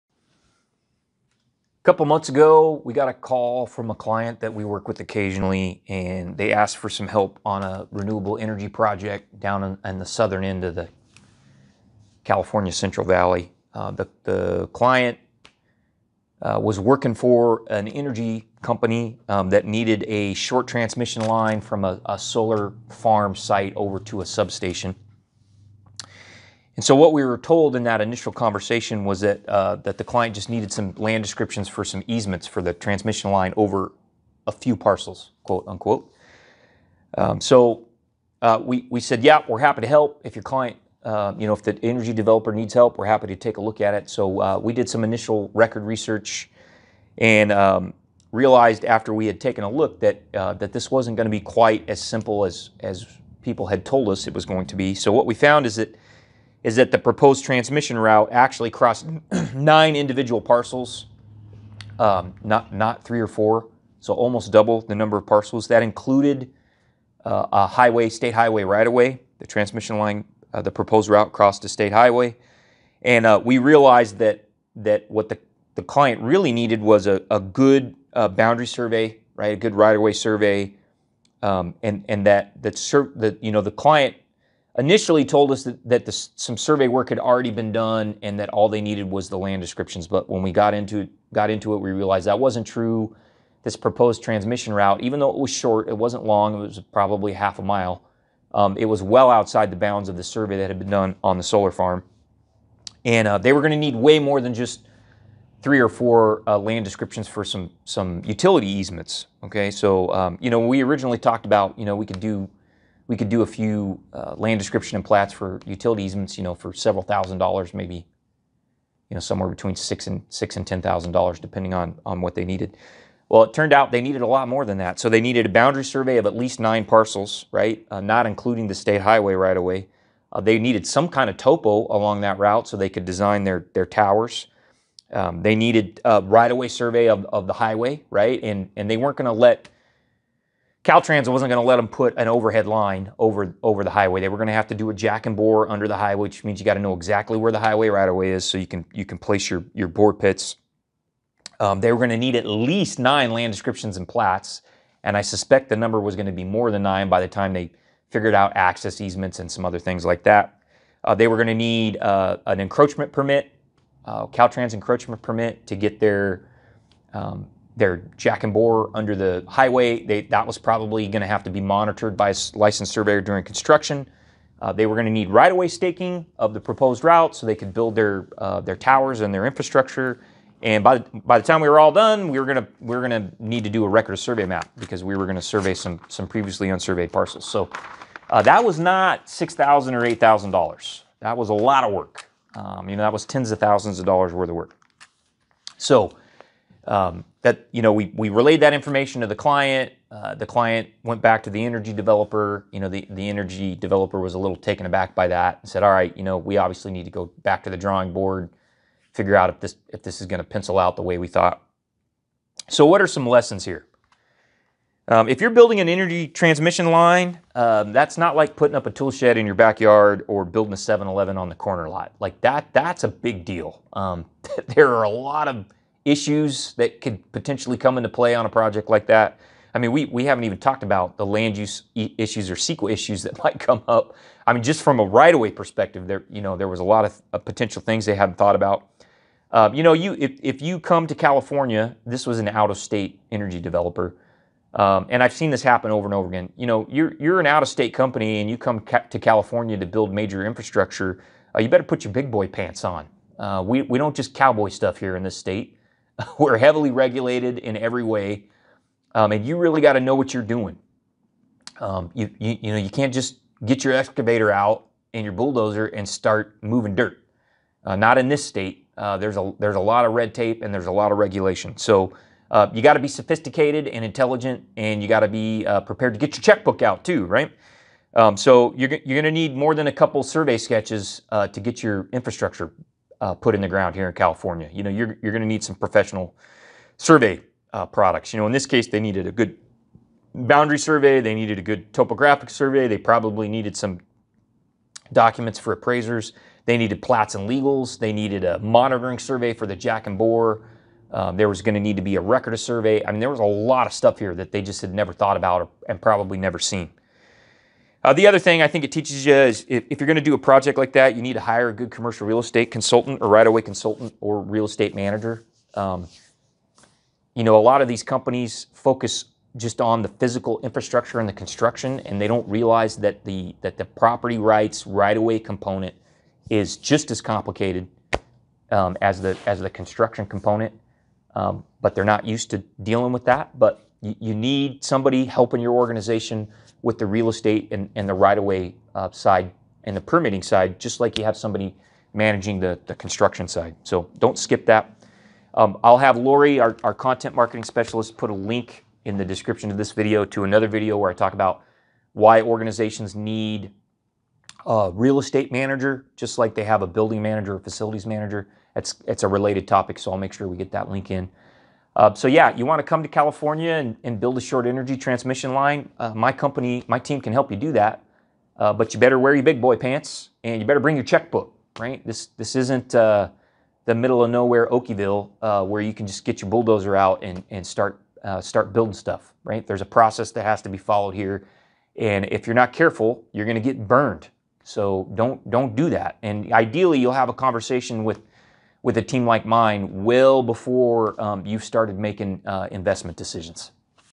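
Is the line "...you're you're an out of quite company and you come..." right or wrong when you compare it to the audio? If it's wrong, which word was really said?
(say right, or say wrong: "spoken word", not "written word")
wrong: "state", not "quite".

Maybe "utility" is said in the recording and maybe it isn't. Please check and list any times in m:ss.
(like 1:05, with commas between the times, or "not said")
1:48, 1:55.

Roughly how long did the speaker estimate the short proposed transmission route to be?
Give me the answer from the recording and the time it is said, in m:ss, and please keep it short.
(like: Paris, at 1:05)
half a mile, at 1:37.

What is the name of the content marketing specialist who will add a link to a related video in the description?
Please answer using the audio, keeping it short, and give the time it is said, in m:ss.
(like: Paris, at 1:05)
Lori, at 5:46.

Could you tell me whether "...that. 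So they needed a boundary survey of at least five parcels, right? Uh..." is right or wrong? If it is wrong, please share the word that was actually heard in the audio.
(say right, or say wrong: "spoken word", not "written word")
wrong: "nine", not "five".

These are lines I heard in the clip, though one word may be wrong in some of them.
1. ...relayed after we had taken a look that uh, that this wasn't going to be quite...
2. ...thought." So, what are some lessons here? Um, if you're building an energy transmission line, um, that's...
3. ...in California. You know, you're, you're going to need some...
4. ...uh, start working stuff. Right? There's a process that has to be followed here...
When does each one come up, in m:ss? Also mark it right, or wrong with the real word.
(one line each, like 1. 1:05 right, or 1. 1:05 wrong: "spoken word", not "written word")
1. 0:48 wrong: "realized", not "relayed"
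2. 3:31 right
3. 4:44 right
4. 6:18 wrong: "building", not "working".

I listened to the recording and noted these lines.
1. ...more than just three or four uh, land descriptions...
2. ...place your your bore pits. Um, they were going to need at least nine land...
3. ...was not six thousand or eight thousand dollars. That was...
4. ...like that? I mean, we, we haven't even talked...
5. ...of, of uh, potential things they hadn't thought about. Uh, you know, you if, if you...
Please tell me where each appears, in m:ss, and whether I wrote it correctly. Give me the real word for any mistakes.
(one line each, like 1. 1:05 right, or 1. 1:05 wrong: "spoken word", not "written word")
1. 1:44 right
2. 2:29 right
3. 3:08 right
4. 3:48 right
5. 3:57 right.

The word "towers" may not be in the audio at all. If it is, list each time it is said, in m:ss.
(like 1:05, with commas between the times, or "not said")
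2:13, 2:58.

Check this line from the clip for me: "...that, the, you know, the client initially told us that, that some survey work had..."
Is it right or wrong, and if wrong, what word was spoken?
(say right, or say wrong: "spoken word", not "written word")
right.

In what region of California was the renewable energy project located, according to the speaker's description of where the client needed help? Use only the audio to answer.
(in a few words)
Central Valley.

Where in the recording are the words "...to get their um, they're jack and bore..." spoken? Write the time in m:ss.
2:45.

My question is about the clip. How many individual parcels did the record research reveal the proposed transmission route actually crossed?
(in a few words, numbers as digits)
9.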